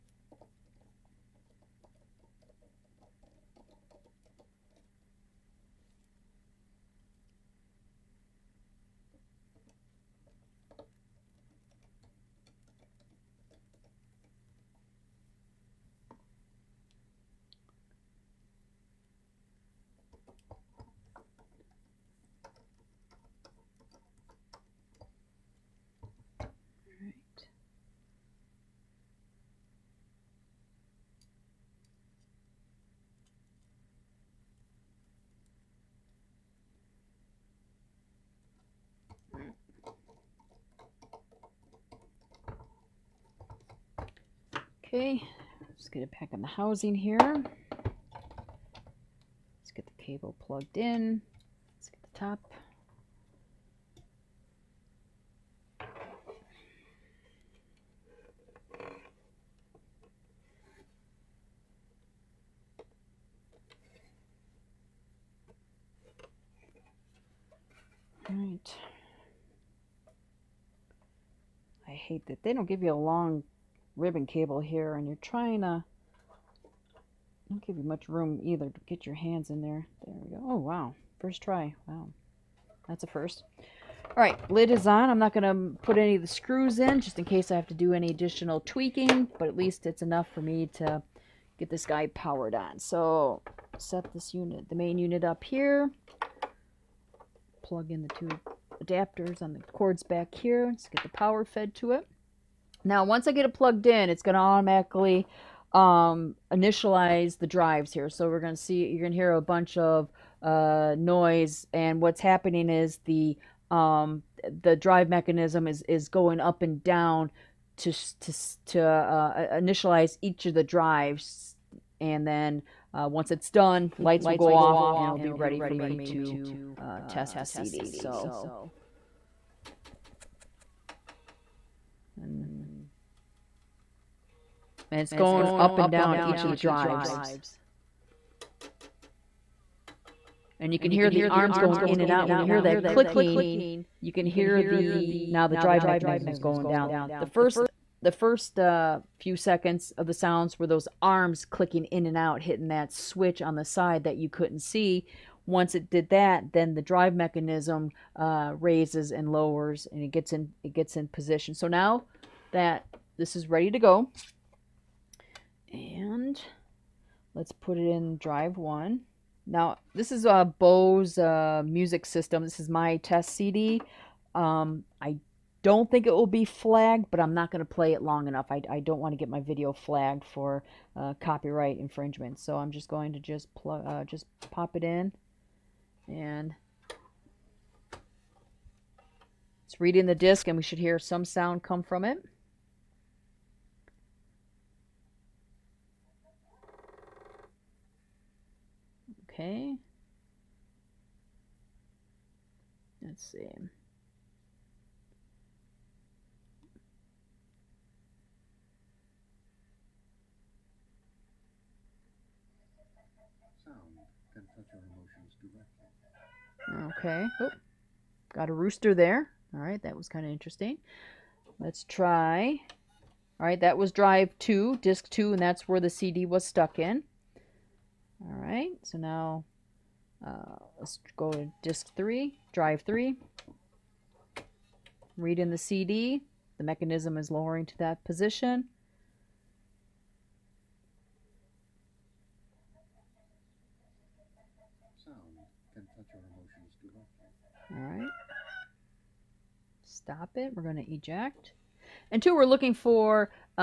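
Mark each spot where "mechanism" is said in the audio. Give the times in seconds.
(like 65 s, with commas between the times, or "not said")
115 s, 145 s, 157 s, 236 s.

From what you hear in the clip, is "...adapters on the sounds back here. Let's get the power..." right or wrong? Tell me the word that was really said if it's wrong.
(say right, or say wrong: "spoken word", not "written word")
wrong: "cords", not "sounds".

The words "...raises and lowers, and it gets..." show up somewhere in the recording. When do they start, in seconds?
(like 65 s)
158 s.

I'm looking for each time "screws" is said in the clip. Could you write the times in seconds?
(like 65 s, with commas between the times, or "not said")
86 s.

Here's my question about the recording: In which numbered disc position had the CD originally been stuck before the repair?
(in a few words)
2.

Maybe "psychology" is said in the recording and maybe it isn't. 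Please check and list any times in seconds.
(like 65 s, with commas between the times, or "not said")
not said.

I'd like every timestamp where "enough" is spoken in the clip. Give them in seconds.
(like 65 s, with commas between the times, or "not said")
90 s, 178 s.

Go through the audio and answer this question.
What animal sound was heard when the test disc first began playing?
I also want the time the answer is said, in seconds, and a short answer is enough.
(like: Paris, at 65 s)
Rooster, at 218 s.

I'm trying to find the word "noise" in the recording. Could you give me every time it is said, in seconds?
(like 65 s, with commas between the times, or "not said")
110 s.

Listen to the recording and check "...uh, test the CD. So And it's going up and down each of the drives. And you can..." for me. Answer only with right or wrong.
right.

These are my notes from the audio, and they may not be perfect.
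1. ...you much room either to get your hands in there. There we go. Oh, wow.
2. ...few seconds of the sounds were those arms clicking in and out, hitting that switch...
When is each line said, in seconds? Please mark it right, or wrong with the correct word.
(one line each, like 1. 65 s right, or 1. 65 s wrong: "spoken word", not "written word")
1. 77 s right
2. 149 s right.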